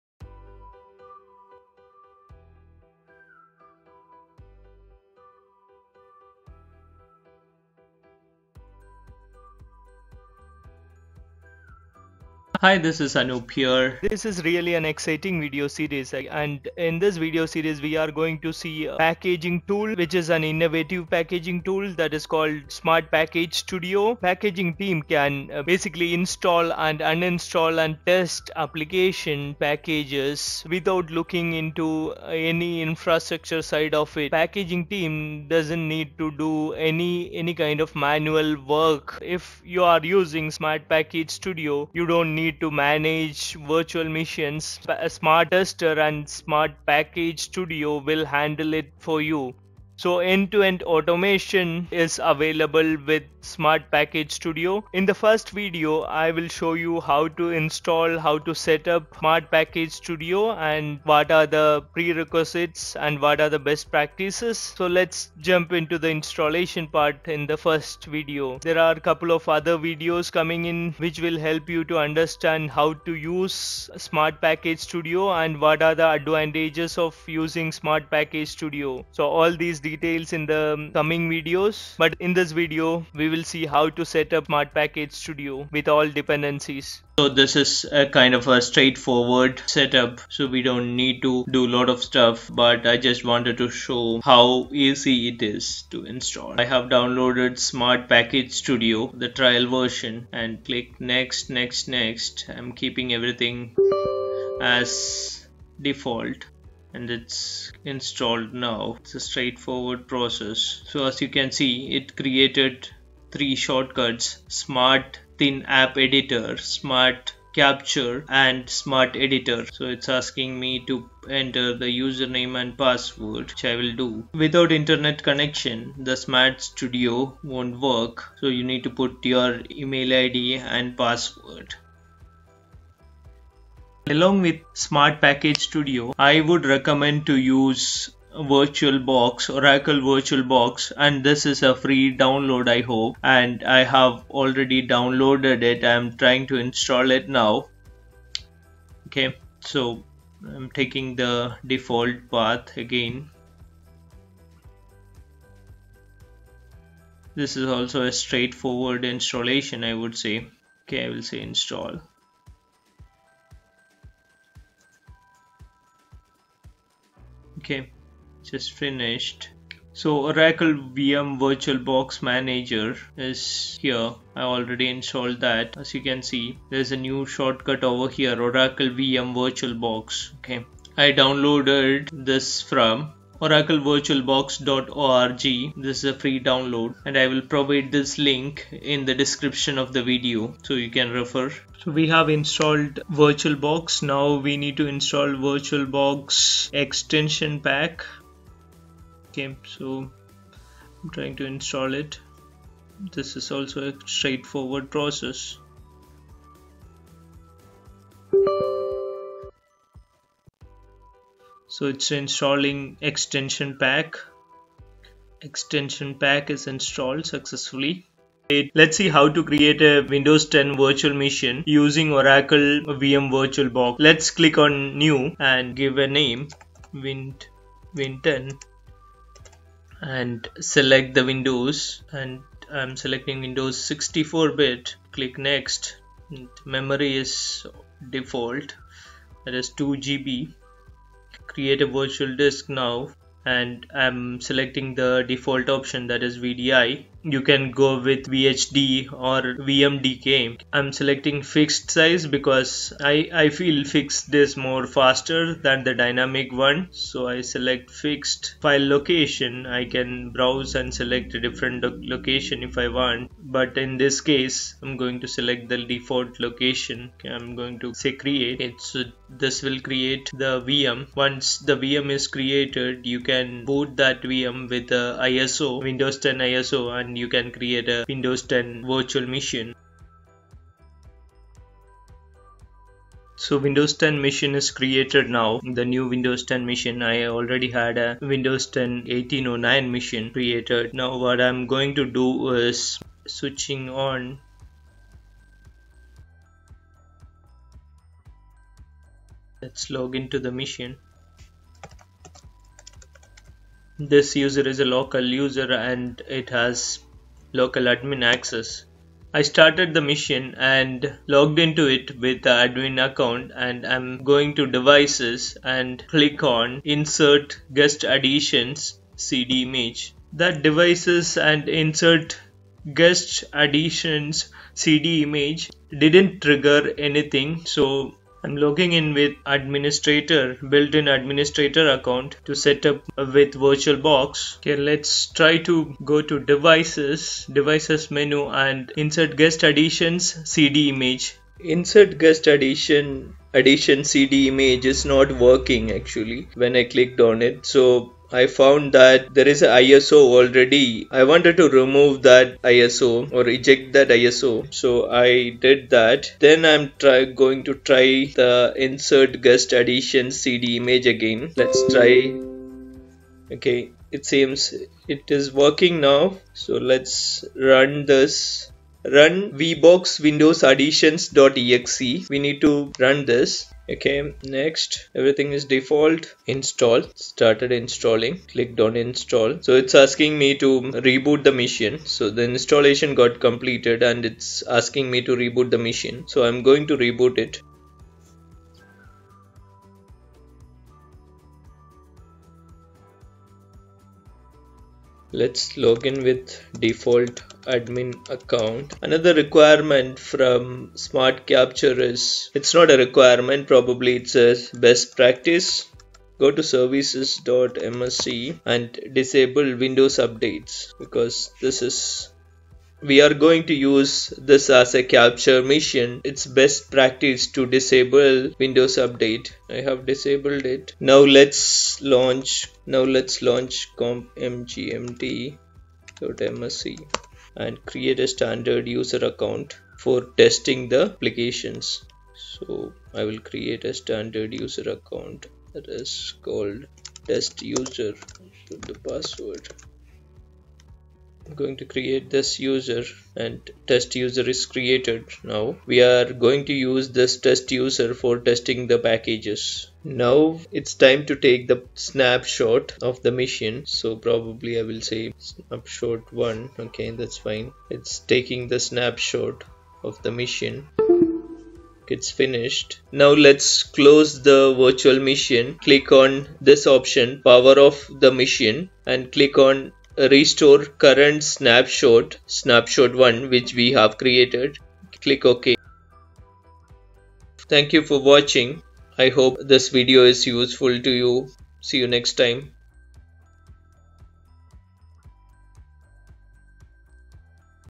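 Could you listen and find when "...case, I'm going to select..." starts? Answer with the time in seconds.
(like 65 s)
264 s.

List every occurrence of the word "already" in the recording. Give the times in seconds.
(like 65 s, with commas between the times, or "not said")
144 s, 174 s, 287 s, 350 s.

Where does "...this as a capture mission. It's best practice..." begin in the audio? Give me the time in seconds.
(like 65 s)
414 s.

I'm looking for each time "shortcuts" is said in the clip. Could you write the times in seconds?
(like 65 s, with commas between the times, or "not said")
113 s, 177 s.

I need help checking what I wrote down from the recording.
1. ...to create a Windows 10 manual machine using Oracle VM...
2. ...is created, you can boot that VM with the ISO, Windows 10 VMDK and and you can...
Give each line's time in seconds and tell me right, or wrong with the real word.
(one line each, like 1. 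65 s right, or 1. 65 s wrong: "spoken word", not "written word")
1. 219 s wrong: "virtual", not "manual"
2. 272 s wrong: "ISO", not "VMDK".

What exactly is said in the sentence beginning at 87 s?
So this is a kind of a straightforward setup.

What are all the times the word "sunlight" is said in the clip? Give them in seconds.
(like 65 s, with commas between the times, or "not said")
not said.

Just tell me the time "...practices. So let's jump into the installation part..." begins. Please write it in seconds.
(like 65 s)
63 s.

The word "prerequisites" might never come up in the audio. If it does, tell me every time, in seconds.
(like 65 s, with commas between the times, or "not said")
61 s.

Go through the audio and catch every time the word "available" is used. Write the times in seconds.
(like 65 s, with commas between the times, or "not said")
52 s.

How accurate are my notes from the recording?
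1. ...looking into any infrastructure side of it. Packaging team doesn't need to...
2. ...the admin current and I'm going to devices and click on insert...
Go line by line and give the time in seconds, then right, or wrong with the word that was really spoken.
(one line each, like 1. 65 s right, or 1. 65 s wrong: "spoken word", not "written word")
1. 31 s right
2. 312 s wrong: "account", not "current".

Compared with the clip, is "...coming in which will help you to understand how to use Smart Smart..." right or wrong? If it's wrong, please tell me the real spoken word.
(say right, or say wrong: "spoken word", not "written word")
wrong: "Package", not "Smart".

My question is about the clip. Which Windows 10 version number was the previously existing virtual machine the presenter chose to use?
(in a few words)
1809.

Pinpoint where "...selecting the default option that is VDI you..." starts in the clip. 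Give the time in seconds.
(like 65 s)
244 s.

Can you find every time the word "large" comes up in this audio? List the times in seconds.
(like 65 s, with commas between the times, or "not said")
not said.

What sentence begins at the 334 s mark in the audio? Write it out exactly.
Okay, let's try to go to devices, devices menu and insert guest additions CD image.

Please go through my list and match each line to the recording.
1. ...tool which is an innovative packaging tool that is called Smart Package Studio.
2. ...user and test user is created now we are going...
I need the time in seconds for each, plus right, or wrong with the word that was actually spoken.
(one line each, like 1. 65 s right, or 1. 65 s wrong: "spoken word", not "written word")
1. 19 s right
2. 442 s right.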